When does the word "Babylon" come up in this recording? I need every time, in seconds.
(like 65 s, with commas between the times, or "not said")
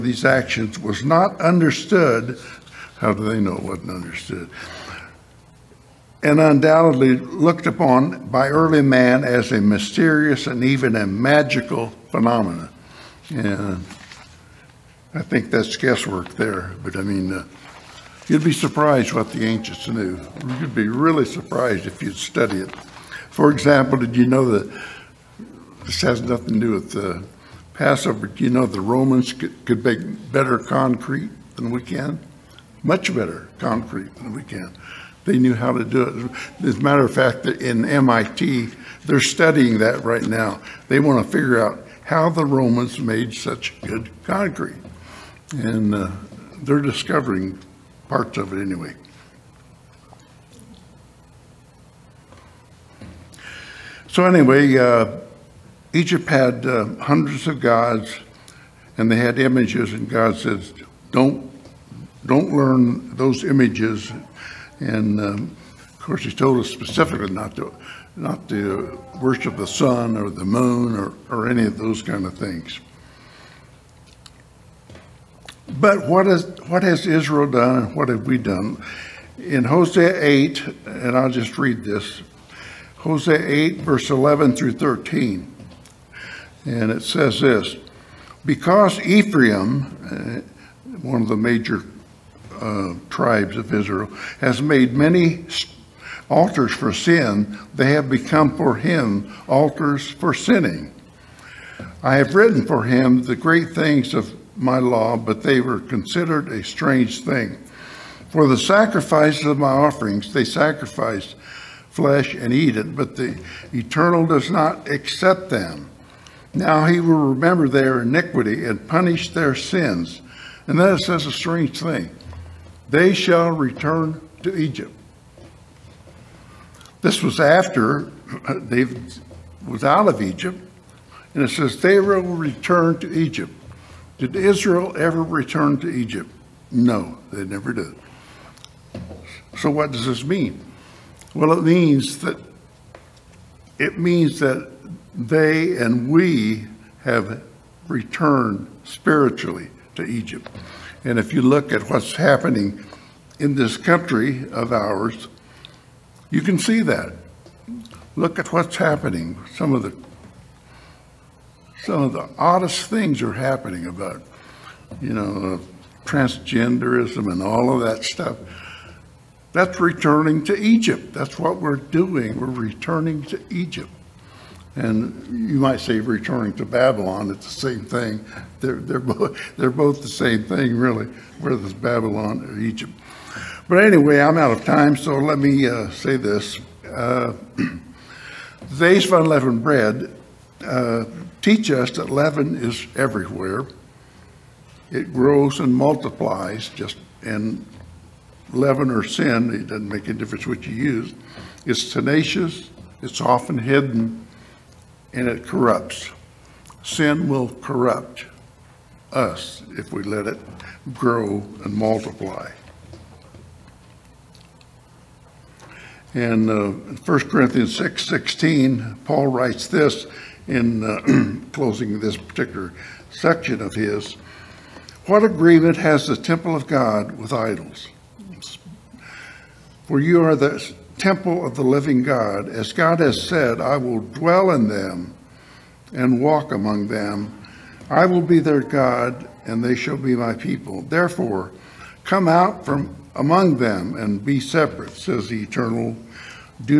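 176 s, 181 s.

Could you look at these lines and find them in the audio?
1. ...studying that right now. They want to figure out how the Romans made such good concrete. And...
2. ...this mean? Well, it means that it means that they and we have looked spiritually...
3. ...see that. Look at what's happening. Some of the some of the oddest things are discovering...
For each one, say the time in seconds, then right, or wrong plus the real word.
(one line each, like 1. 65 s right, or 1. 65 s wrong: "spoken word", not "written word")
1. 39 s right
2. 140 s wrong: "returned", not "looked"
3. 156 s wrong: "happening", not "discovering".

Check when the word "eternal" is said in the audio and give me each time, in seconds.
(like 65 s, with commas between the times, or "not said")
113 s, 245 s.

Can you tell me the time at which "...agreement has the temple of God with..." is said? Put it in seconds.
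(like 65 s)
225 s.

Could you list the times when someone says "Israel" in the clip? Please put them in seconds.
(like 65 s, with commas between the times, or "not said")
77 s, 93 s, 134 s.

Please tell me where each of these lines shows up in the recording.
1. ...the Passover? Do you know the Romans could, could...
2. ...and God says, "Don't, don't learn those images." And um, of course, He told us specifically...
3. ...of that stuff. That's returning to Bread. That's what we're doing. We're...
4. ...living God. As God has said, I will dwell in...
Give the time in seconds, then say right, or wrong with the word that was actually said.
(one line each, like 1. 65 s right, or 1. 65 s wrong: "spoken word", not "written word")
1. 26 s right
2. 59 s right
3. 167 s wrong: "Egypt", not "Bread"
4. 231 s right.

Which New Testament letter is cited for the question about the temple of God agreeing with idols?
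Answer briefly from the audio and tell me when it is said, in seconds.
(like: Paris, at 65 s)
1 Corinthians, at 216 s.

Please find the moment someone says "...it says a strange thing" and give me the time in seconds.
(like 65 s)
120 s.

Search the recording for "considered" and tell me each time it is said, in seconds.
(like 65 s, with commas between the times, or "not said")
105 s.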